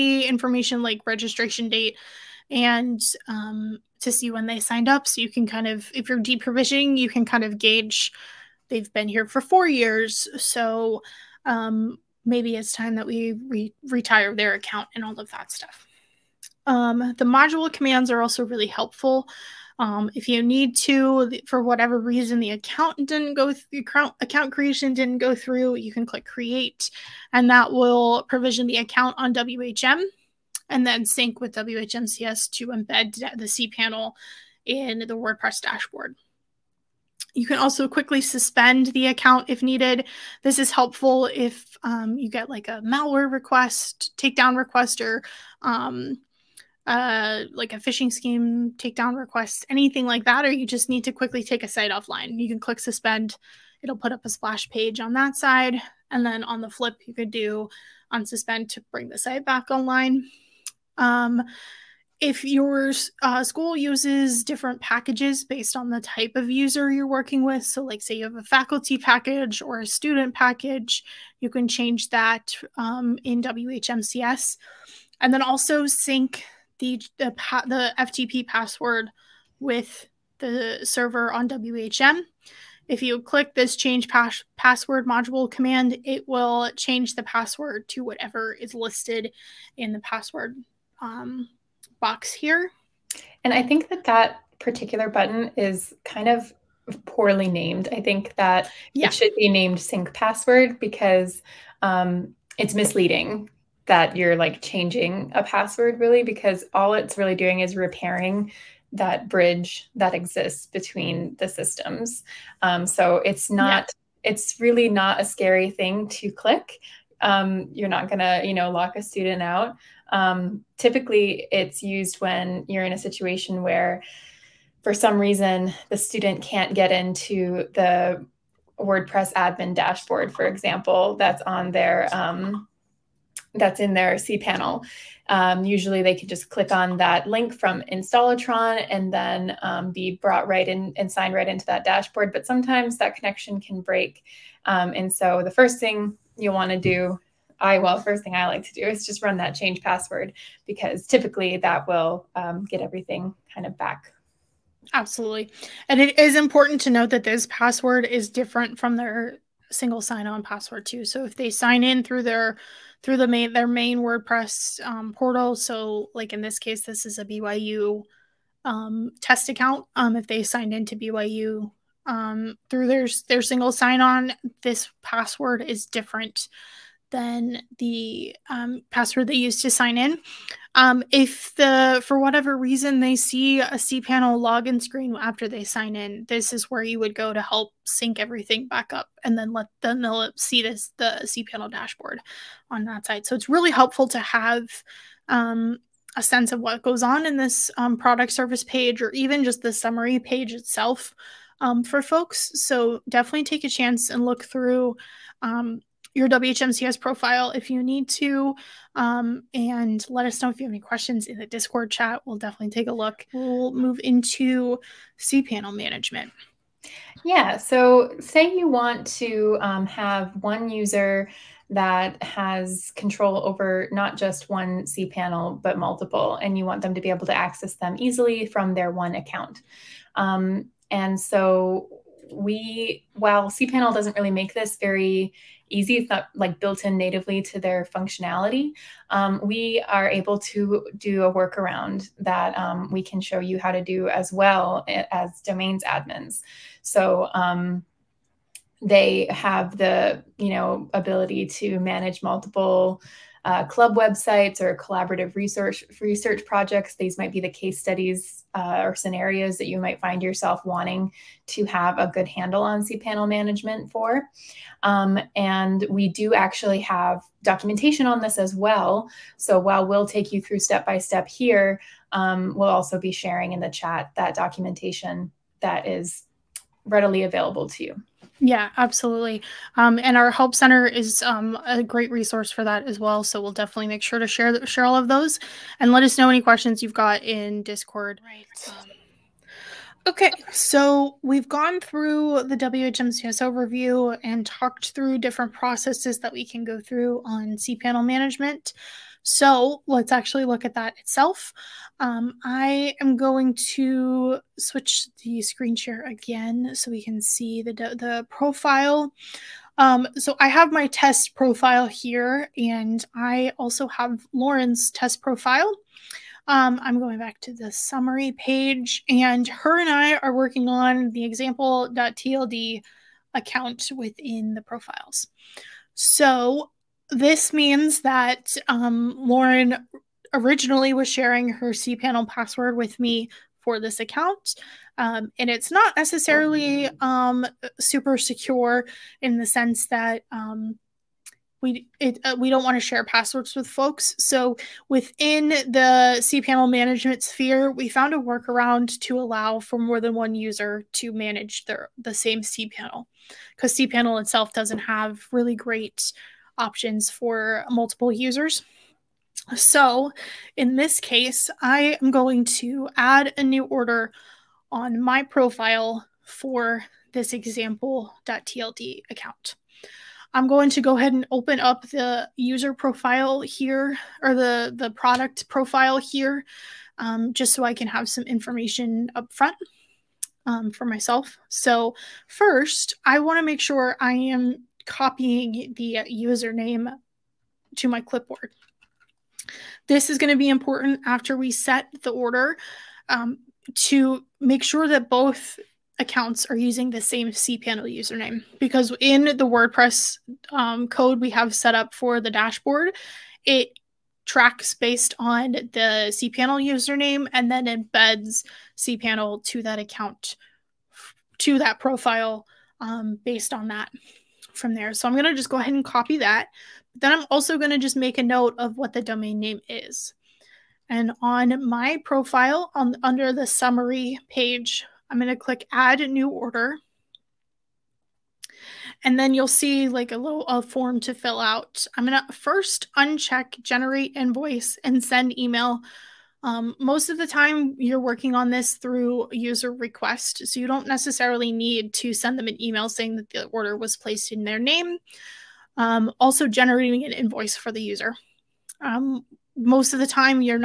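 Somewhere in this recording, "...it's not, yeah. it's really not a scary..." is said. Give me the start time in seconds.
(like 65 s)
113 s.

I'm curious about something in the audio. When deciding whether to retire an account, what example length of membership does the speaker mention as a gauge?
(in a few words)
4 years.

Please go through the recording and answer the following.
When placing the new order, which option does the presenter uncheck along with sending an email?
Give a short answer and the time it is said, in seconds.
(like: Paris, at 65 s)
generate invoice, at 433 s.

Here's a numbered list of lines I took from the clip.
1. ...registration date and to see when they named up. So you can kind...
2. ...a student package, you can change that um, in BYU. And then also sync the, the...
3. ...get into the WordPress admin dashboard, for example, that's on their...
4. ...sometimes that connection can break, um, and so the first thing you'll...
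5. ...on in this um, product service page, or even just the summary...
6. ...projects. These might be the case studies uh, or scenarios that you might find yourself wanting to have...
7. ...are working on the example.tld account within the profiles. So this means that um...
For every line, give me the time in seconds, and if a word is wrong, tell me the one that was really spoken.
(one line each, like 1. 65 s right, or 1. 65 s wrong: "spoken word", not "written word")
1. 1 s wrong: "signed", not "named"
2. 69 s wrong: "WHMCS", not "BYU"
3. 126 s right
4. 142 s right
5. 197 s right
6. 256 s right
7. 320 s right.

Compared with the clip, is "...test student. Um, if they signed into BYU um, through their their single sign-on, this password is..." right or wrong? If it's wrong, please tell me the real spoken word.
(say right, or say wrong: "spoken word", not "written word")
wrong: "account", not "student".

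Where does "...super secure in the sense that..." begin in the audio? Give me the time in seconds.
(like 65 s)
337 s.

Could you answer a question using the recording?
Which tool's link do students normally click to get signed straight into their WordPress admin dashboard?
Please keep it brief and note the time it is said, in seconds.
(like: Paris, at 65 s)
Installatron, at 137 s.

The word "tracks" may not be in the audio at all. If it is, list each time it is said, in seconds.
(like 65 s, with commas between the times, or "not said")
404 s.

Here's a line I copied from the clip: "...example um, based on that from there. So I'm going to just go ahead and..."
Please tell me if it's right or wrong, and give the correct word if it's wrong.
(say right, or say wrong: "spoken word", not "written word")
wrong: "profile", not "example".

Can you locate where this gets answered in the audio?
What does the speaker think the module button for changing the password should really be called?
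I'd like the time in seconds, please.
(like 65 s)
99 s.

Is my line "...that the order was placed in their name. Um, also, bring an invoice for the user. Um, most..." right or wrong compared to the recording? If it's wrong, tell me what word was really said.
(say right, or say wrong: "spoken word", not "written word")
wrong: "generating", not "bring".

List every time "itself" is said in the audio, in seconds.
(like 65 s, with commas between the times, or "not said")
200 s, 300 s, 354 s.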